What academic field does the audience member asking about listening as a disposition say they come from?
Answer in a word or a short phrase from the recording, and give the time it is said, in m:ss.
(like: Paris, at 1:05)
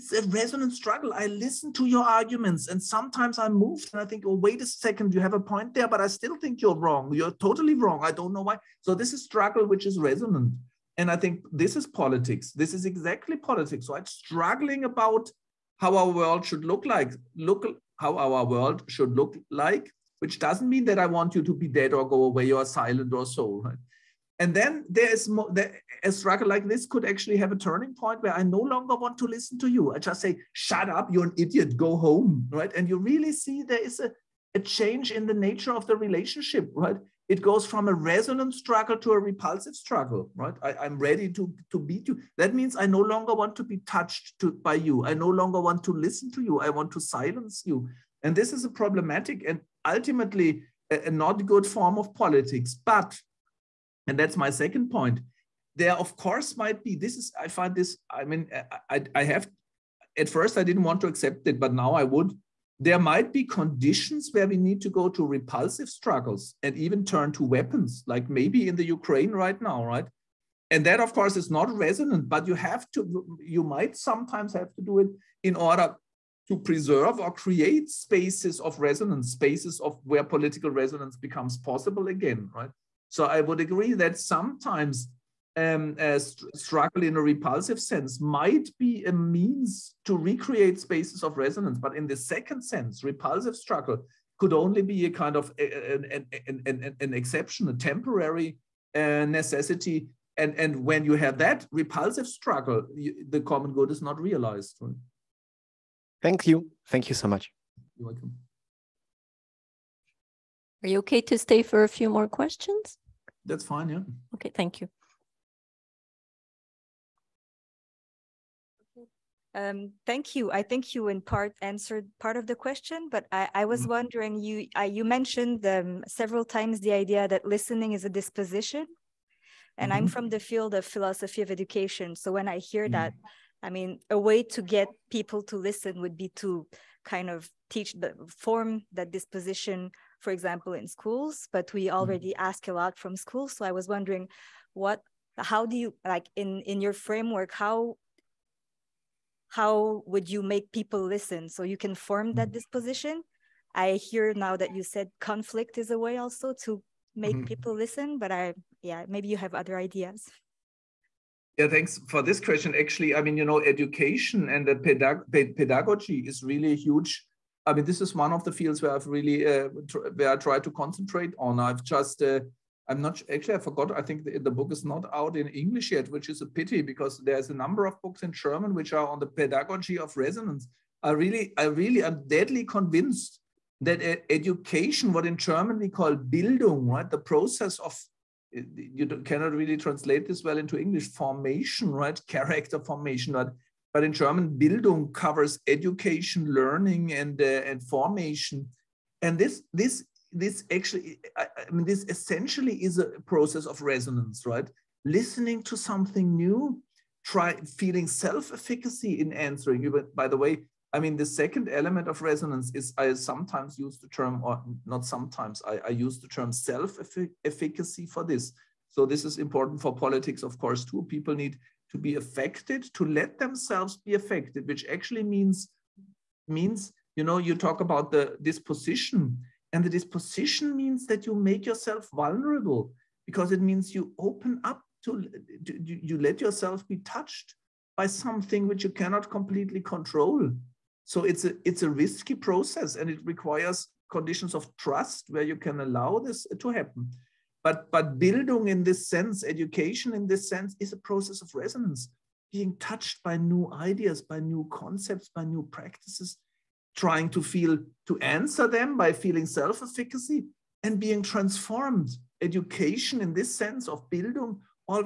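philosophy of education, at 2:10.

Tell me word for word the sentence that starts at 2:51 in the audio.
I've just uh, I'm not actually I forgot.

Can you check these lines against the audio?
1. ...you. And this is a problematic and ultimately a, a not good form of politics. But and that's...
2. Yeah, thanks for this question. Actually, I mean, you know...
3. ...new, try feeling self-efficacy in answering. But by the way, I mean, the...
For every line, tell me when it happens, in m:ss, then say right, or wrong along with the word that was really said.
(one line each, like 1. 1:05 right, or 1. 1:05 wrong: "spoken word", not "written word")
1. 0:47 right
2. 2:41 right
3. 3:26 right.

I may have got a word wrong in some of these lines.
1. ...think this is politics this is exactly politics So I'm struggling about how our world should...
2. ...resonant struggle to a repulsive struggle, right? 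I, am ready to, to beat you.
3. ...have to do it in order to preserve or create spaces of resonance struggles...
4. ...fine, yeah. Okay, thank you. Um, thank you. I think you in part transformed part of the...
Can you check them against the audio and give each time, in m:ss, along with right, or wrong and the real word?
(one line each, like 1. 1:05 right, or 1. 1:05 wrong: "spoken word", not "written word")
1. 0:11 right
2. 0:37 right
3. 1:14 wrong: "spaces", not "struggles"
4. 1:53 wrong: "answered", not "transformed".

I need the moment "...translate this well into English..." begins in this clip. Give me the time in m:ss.
3:09.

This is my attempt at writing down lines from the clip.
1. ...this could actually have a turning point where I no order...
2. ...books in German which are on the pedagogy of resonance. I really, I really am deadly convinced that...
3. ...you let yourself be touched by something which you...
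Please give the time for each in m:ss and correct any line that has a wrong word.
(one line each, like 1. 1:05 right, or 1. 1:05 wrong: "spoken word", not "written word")
1. 0:26 wrong: "longer", not "order"
2. 2:58 right
3. 3:56 right.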